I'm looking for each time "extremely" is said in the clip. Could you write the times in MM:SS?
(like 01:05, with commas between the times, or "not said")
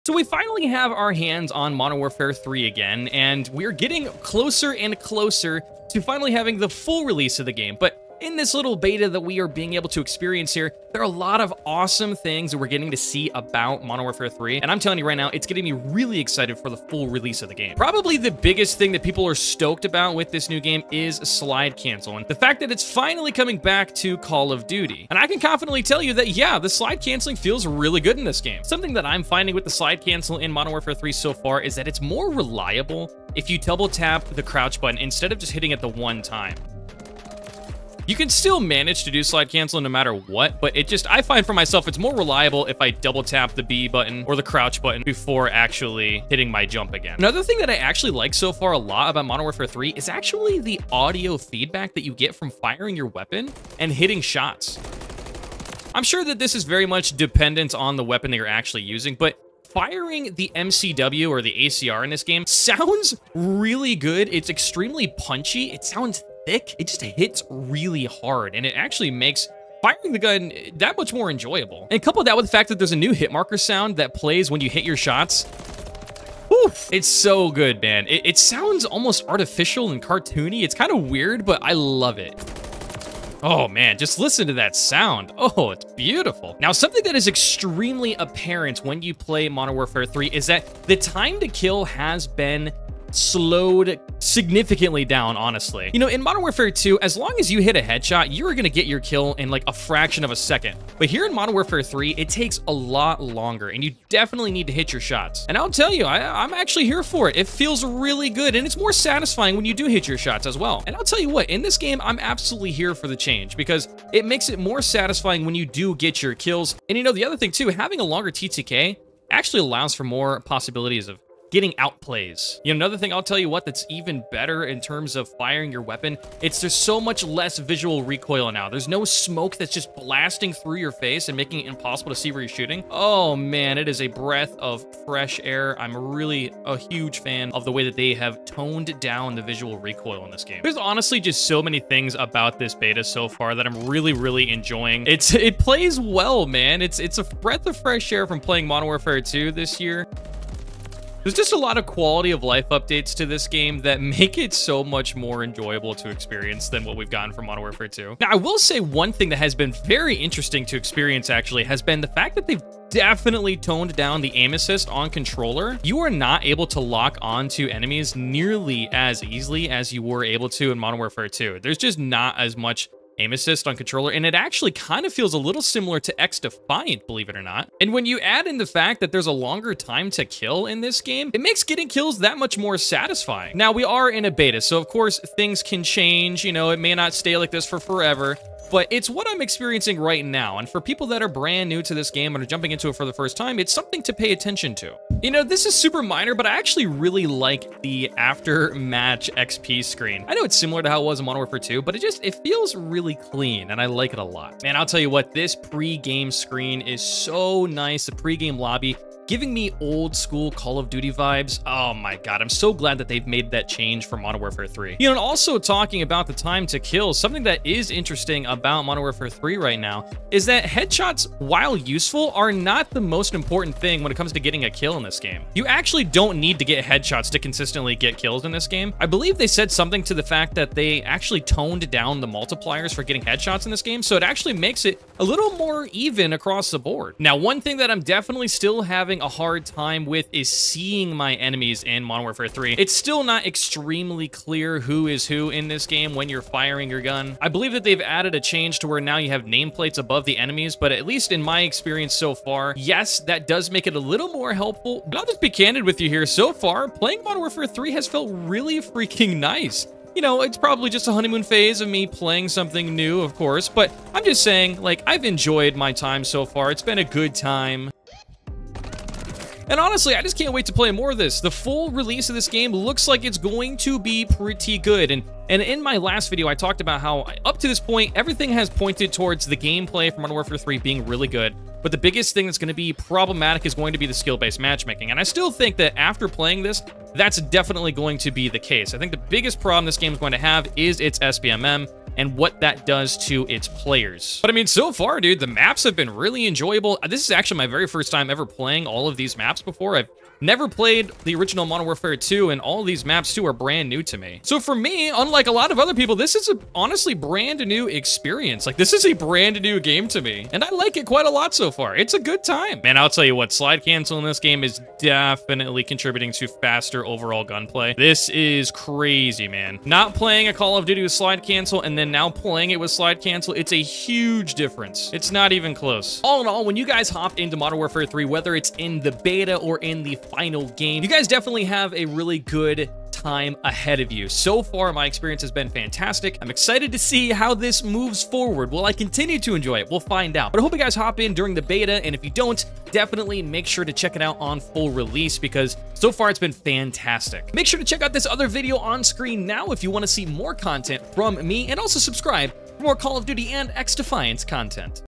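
01:04, 01:27, 04:03.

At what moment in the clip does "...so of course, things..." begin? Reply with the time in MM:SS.
03:04.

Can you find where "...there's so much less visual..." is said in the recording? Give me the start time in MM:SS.
02:06.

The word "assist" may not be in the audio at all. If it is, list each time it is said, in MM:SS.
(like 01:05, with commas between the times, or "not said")
02:44, 02:53.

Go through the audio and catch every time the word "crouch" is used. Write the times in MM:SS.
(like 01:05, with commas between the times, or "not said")
00:34, 00:44.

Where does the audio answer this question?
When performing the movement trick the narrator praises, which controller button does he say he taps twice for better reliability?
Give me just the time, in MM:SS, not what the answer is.
00:43.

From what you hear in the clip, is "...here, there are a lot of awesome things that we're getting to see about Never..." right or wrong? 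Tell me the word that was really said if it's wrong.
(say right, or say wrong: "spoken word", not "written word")
wrong: "Modern", not "Never".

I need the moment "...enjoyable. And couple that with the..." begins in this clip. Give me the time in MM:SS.
01:11.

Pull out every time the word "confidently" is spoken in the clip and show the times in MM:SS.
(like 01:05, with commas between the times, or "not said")
00:25.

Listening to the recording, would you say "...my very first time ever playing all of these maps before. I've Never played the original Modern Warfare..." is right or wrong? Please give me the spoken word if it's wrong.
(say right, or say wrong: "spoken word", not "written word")
right.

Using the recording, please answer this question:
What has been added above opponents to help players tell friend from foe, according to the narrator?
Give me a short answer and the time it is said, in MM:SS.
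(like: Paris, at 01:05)
Nameplates, at 04:09.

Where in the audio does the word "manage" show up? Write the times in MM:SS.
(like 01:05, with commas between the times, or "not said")
00:38.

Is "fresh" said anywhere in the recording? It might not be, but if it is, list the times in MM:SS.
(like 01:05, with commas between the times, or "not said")
02:15, 02:27.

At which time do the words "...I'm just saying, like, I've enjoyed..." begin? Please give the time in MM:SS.
04:24.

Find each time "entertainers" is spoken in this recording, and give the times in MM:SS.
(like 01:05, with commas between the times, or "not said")
not said.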